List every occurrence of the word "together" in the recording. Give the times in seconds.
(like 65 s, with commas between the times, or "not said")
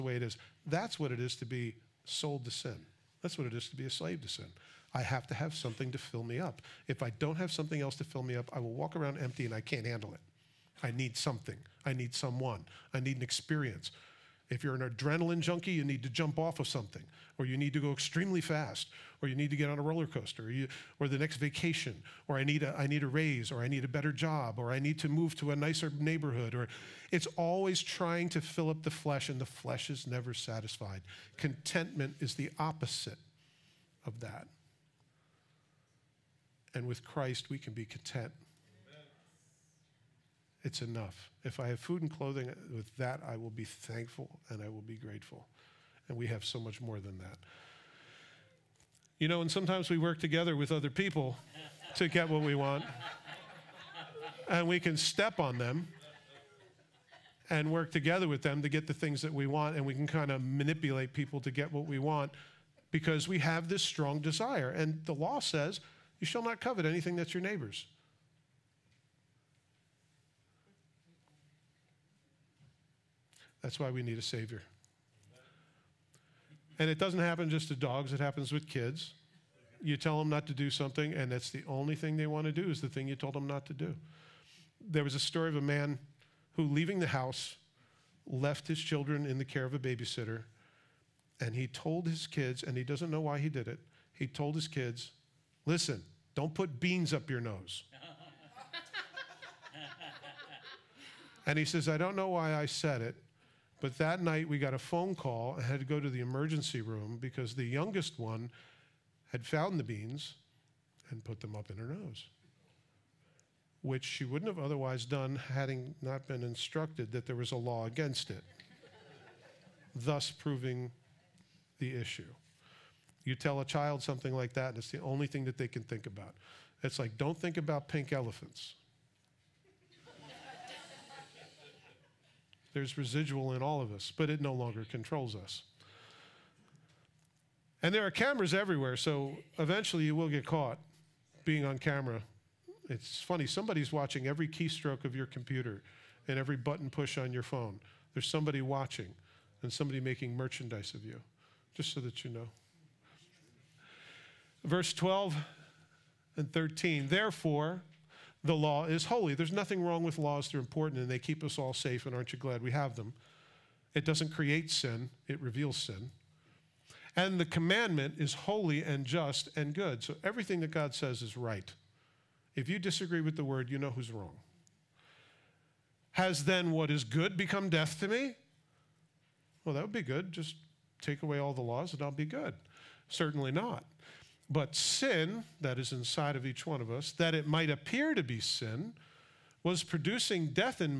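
50 s, 57 s.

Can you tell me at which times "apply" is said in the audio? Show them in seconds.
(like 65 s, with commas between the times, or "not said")
not said.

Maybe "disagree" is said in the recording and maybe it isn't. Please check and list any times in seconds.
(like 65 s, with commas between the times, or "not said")
172 s.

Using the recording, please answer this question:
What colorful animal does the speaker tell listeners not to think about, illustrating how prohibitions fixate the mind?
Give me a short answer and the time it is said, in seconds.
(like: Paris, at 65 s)
pink elephants, at 127 s.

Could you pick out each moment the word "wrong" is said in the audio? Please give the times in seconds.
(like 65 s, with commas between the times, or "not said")
159 s, 174 s.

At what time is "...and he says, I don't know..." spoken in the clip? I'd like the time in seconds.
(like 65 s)
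101 s.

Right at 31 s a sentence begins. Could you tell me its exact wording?
Contentment is the opposite of that.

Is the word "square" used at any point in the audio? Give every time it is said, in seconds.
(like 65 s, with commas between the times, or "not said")
not said.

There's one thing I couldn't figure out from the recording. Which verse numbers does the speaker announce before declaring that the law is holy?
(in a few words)
12 and 13.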